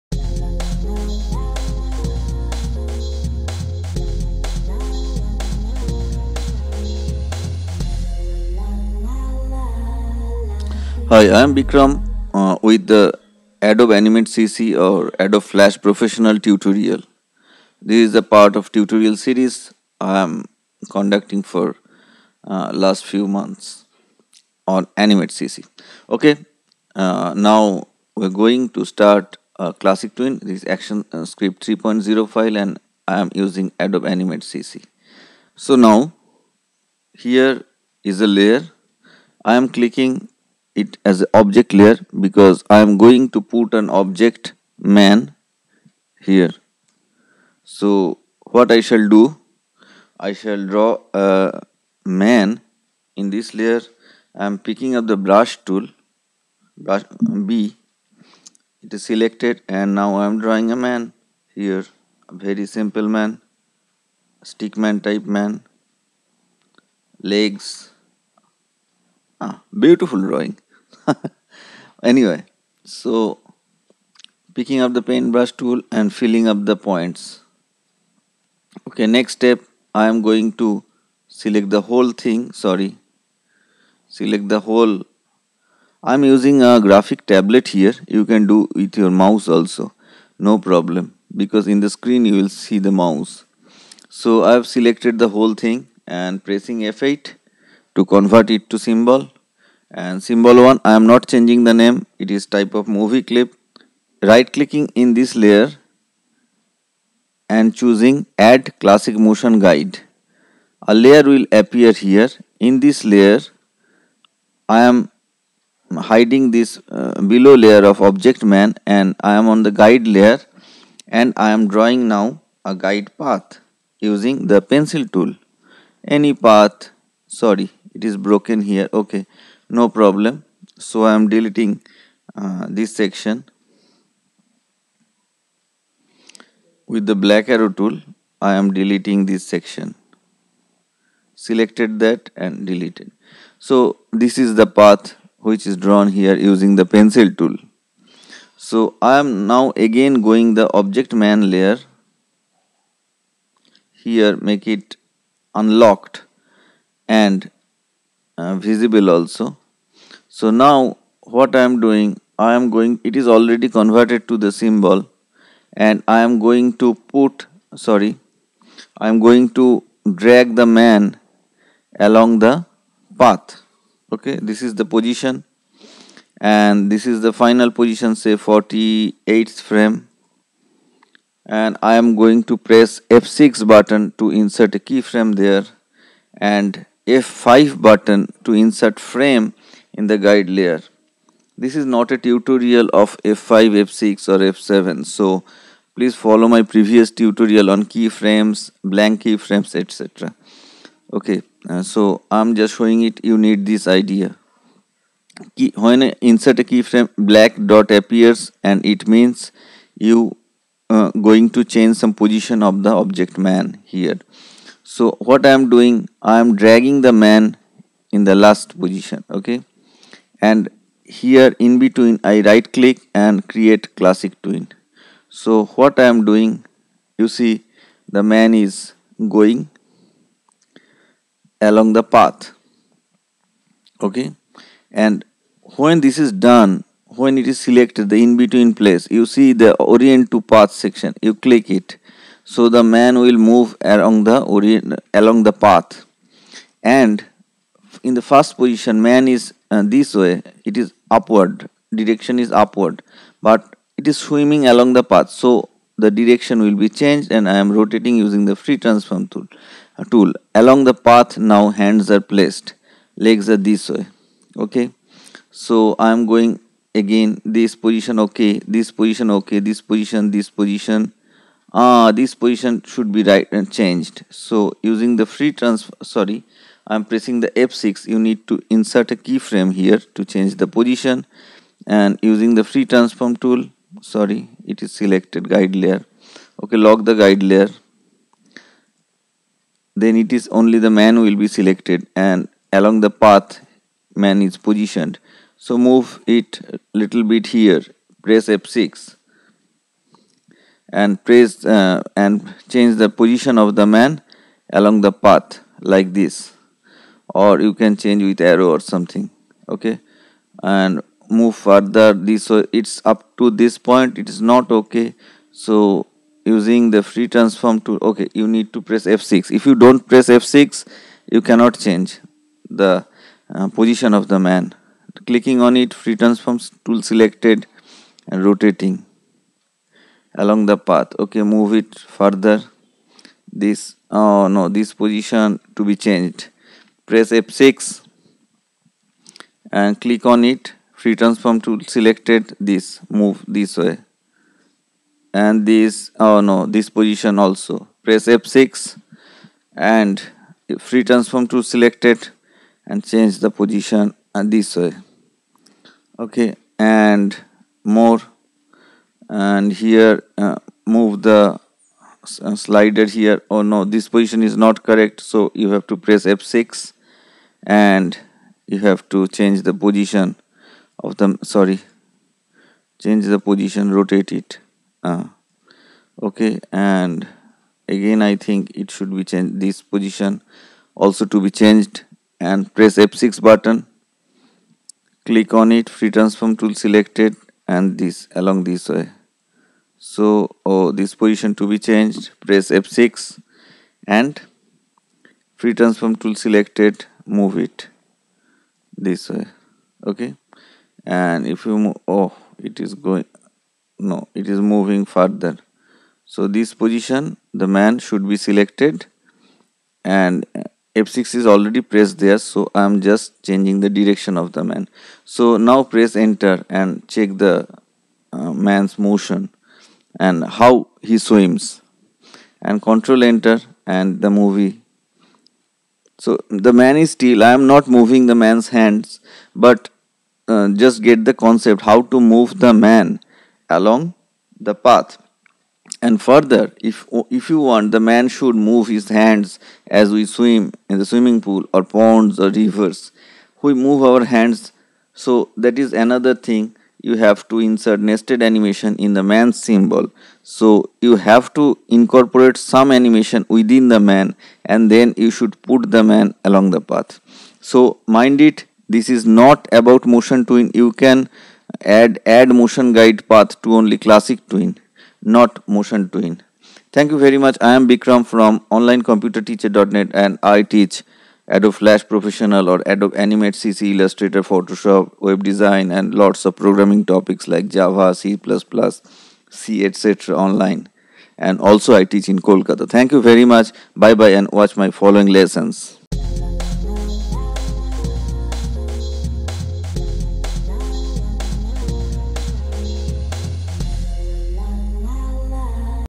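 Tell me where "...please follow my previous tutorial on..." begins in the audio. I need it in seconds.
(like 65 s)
195 s.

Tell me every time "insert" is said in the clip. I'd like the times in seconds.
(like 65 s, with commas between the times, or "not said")
184 s, 188 s, 206 s, 278 s, 447 s.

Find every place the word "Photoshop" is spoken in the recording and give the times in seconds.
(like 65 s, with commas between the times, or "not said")
474 s.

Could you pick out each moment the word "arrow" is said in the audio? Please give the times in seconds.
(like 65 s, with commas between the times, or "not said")
137 s, 308 s.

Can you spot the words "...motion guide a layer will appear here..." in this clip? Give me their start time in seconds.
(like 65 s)
109 s.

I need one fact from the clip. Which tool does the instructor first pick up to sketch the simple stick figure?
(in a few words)
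Brush tool.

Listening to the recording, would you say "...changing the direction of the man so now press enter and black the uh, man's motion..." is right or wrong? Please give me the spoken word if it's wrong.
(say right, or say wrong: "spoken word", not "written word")
wrong: "check", not "black".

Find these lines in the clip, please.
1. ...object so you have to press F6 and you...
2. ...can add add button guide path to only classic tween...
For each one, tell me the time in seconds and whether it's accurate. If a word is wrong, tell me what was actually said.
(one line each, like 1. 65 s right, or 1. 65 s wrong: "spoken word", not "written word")
1. 364 s wrong: "correct", not "object"
2. 461 s wrong: "motion", not "button".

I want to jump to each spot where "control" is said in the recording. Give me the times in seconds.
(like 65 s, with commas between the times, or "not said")
422 s.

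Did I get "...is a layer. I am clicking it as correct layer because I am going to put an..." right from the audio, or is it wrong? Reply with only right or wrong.
wrong.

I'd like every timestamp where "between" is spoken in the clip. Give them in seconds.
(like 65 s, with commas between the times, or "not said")
221 s, 238 s.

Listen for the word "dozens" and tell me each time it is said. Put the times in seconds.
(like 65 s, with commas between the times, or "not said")
not said.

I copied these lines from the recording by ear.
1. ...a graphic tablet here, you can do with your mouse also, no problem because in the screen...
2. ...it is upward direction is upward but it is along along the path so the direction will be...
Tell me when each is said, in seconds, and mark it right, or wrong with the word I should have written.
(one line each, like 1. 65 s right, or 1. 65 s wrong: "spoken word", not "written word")
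1. 86 s right
2. 250 s wrong: "swimming", not "along".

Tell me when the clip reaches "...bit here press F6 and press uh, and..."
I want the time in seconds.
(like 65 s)
297 s.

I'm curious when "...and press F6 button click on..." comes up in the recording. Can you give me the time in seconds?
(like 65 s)
382 s.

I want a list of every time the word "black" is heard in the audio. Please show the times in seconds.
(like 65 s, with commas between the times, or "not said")
137 s, 207 s.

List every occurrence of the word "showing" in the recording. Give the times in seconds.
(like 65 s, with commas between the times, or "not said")
202 s.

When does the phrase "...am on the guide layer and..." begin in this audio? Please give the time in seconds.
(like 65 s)
119 s.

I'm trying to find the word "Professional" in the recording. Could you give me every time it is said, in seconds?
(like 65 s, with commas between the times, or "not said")
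15 s, 472 s.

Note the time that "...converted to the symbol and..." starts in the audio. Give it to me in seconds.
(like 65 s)
163 s.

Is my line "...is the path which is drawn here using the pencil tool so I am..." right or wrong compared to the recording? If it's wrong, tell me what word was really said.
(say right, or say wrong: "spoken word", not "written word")
right.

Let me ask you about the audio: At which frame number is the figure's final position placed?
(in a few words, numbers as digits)
48.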